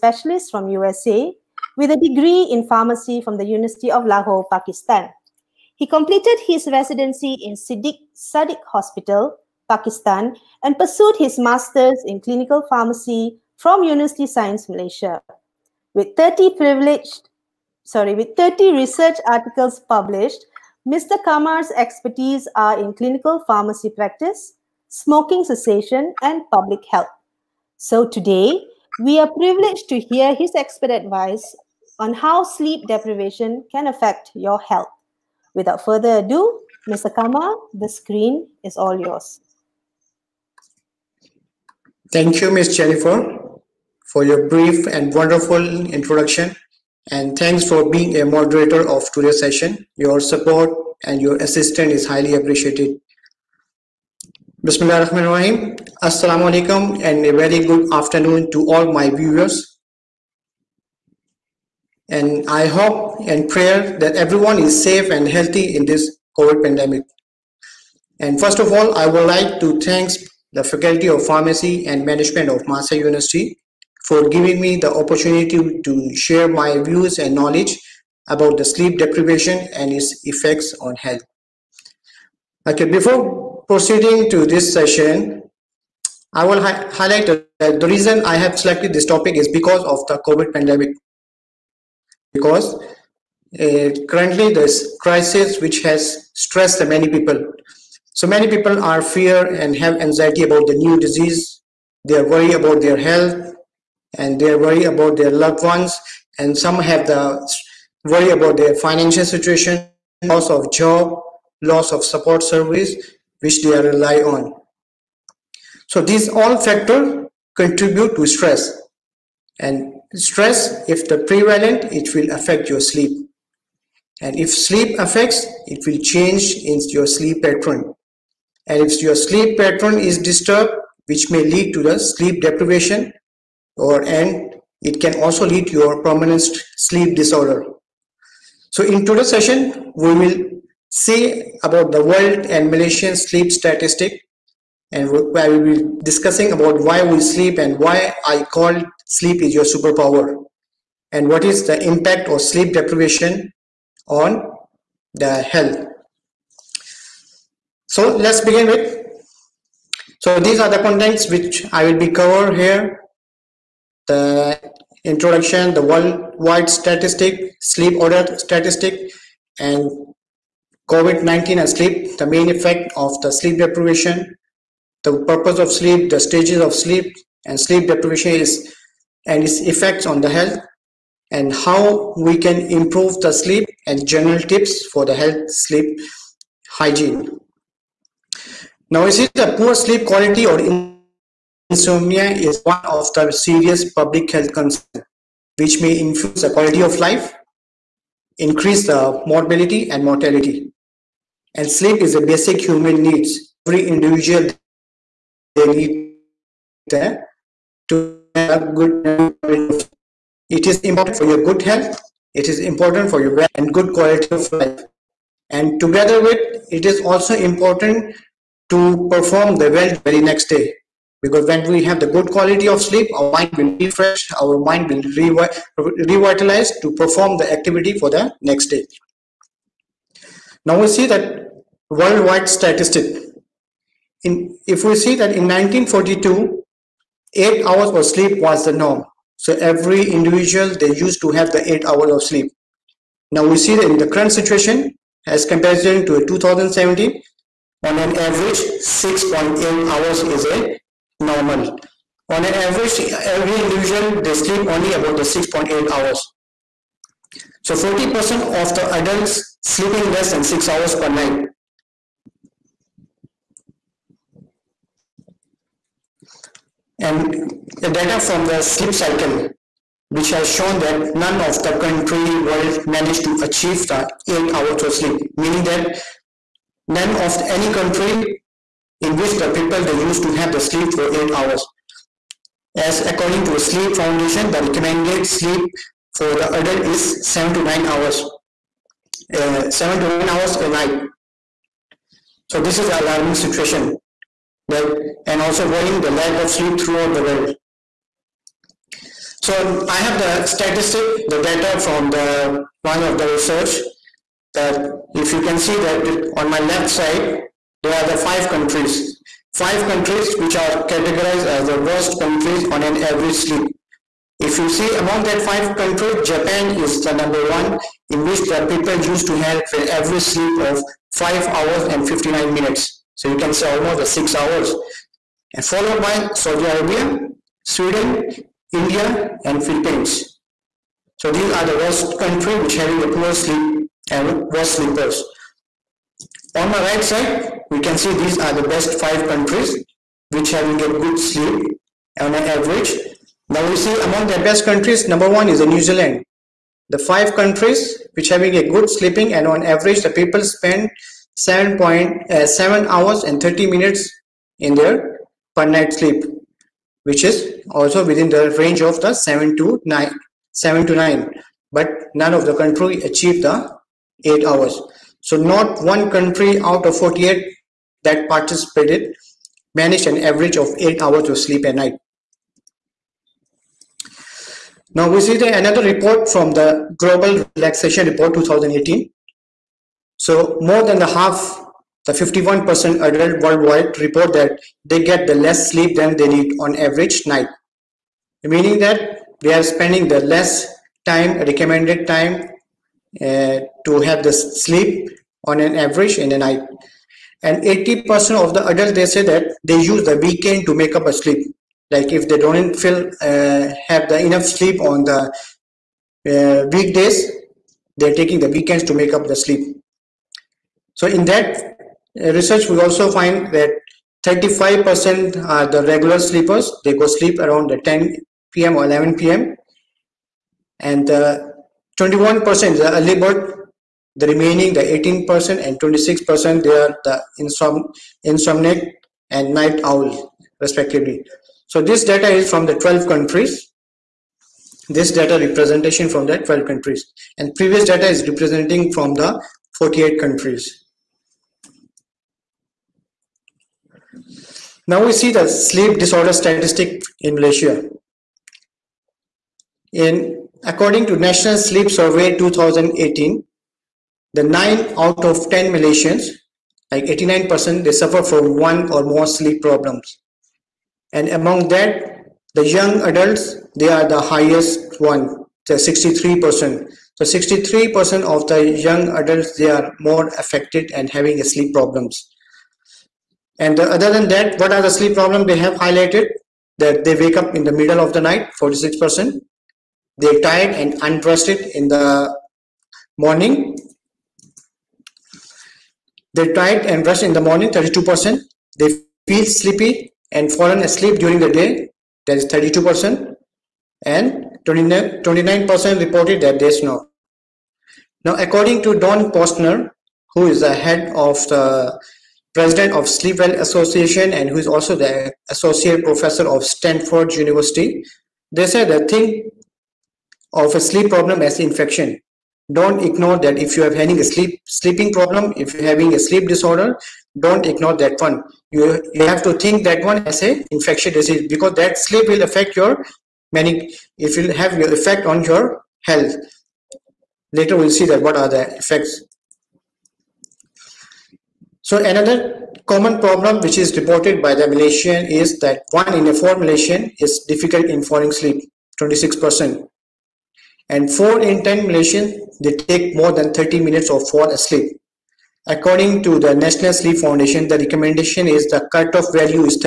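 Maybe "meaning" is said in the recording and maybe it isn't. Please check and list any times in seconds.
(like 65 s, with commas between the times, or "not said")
275 s, 388 s.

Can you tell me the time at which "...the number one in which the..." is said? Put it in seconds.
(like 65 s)
317 s.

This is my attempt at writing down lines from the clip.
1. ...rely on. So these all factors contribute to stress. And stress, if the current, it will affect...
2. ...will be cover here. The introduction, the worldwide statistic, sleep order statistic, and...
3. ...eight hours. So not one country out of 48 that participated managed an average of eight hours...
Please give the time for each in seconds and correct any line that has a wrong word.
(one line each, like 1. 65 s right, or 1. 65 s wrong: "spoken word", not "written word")
1. 113 s wrong: "prevalent", not "current"
2. 161 s right
3. 364 s right.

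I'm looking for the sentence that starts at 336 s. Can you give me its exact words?
On my right side, we can see these are the best five countries which having a good sleep on an average.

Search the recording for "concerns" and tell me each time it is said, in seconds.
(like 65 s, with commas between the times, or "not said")
194 s.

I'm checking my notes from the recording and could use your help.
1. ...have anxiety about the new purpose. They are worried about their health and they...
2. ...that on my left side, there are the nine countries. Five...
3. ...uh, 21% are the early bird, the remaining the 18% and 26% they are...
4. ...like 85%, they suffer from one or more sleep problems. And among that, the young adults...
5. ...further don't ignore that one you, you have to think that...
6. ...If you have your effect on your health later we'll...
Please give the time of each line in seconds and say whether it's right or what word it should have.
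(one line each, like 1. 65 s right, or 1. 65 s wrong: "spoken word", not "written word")
1. 99 s wrong: "disease", not "purpose"
2. 305 s wrong: "five", not "nine"
3. 421 s right
4. 456 s wrong: "89", not "85"
5. 516 s wrong: "disorder", not "further"
6. 524 s right.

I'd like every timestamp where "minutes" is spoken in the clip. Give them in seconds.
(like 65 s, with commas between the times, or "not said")
322 s, 353 s, 543 s.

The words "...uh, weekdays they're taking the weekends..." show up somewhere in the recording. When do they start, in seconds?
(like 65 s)
406 s.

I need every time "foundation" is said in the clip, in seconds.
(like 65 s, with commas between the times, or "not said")
283 s, 547 s.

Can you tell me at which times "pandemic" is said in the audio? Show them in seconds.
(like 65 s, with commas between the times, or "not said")
66 s, 90 s.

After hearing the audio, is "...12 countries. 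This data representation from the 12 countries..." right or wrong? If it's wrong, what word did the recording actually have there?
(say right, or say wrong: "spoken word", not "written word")
right.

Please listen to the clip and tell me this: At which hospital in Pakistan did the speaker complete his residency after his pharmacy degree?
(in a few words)
Siddiq Sadiq Hospital.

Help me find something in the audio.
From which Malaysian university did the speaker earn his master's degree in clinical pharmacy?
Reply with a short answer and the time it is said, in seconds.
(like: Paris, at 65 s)
University Science Malaysia, at 13 s.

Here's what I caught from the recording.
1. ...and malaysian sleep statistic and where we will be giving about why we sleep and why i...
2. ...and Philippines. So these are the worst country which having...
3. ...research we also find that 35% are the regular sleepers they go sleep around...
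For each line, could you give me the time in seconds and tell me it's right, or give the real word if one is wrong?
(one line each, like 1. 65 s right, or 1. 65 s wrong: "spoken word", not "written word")
1. 142 s wrong: "discussing", not "giving"
2. 329 s right
3. 412 s right.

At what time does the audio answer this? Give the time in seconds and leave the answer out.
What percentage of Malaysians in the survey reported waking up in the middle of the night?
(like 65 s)
478 s.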